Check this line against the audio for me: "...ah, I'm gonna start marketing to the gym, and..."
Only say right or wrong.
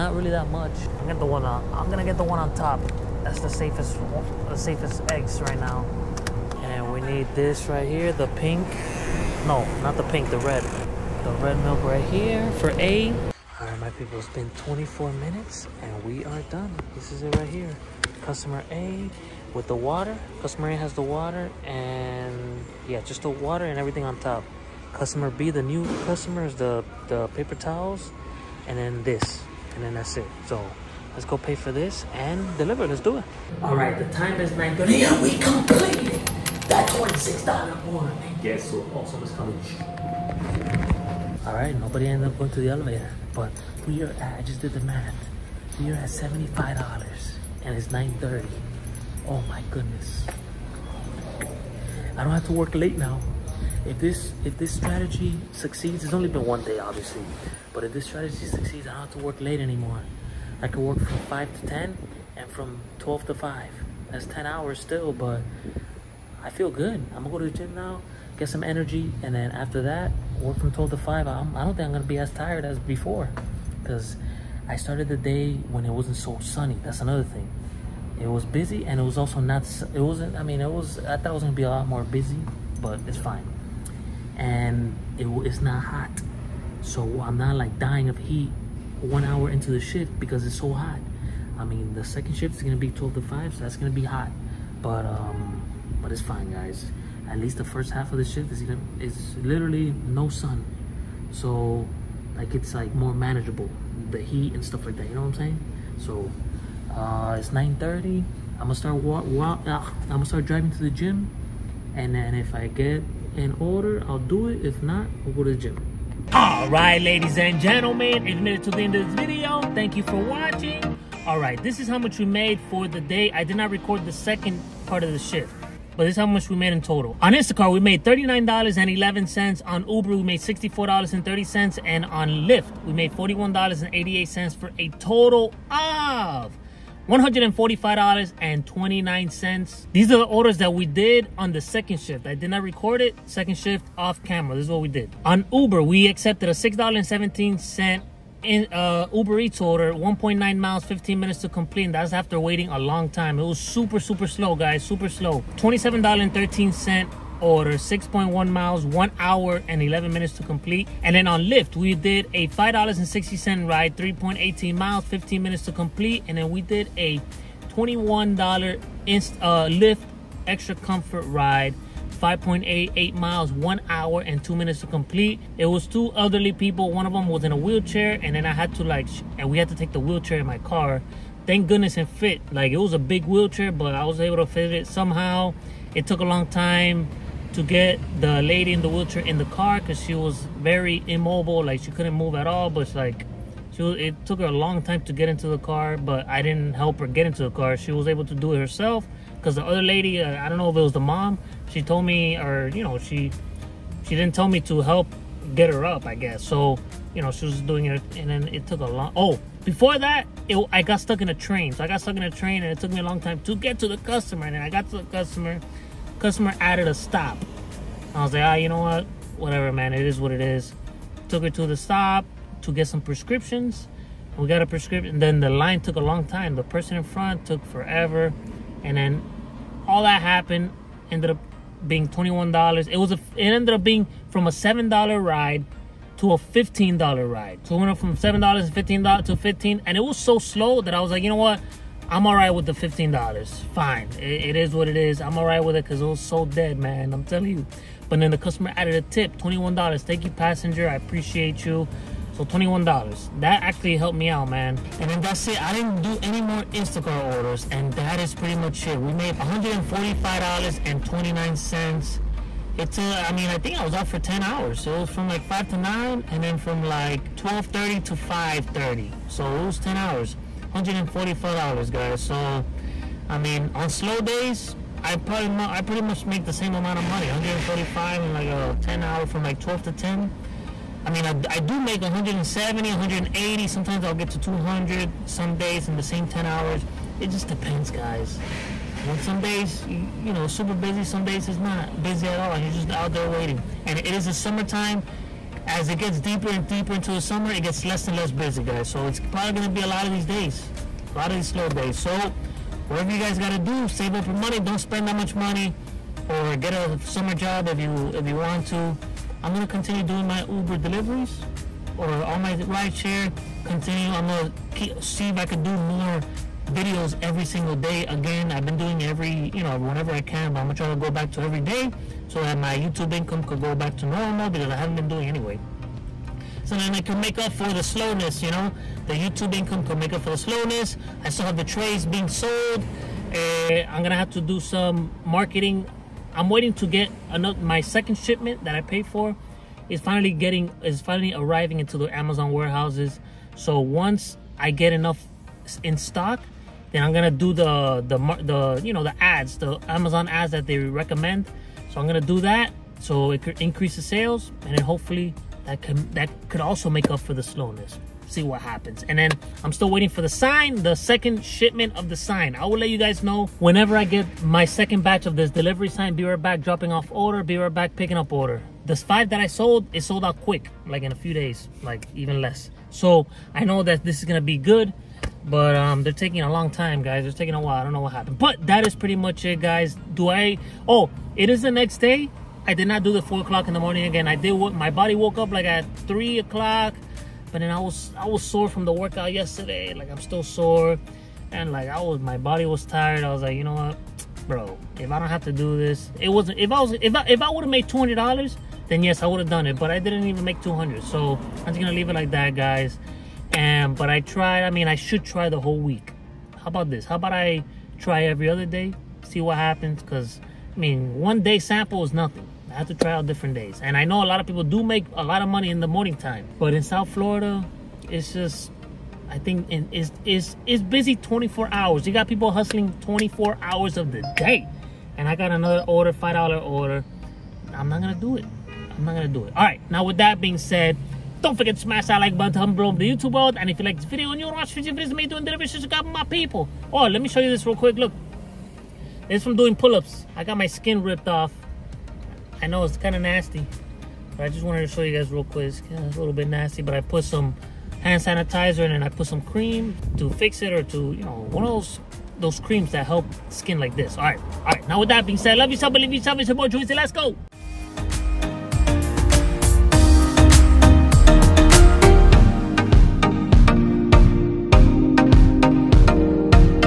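wrong.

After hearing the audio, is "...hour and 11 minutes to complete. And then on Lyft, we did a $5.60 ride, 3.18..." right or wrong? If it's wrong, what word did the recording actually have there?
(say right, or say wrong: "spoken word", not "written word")
right.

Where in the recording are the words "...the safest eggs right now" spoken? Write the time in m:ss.
0:04.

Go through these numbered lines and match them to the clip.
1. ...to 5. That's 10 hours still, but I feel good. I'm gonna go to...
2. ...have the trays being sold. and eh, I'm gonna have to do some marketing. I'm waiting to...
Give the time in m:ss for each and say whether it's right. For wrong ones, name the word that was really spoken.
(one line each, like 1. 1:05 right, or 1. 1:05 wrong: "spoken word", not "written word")
1. 1:03 right
2. 5:31 right.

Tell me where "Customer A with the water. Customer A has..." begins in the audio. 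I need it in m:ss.
0:18.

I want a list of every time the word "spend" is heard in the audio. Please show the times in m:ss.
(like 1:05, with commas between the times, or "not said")
5:04.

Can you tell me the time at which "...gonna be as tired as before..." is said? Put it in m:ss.
1:11.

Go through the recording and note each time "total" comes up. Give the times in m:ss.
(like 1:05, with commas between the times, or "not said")
2:06, 2:14.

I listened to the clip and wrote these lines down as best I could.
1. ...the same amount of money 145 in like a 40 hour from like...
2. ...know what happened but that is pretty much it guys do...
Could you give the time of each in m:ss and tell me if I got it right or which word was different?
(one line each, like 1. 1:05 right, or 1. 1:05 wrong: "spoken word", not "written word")
1. 4:36 wrong: "10", not "40"
2. 6:17 right.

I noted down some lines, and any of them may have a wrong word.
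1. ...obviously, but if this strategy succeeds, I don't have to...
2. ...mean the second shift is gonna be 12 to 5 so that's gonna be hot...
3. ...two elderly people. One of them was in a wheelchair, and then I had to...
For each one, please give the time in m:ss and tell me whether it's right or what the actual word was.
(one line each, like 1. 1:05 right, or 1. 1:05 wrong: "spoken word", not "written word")
1. 0:56 right
2. 1:31 right
3. 2:55 right.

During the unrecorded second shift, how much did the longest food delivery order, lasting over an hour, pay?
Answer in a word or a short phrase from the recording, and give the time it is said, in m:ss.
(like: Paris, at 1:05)
$27.13, at 2:35.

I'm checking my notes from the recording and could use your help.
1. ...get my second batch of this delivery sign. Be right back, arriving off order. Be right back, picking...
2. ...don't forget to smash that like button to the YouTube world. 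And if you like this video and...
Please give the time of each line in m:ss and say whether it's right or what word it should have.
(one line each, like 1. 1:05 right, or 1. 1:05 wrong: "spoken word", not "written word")
1. 6:04 wrong: "dropping", not "arriving"
2. 7:11 right.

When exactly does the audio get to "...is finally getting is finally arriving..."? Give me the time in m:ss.
5:39.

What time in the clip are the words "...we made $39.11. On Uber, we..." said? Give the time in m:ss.
2:07.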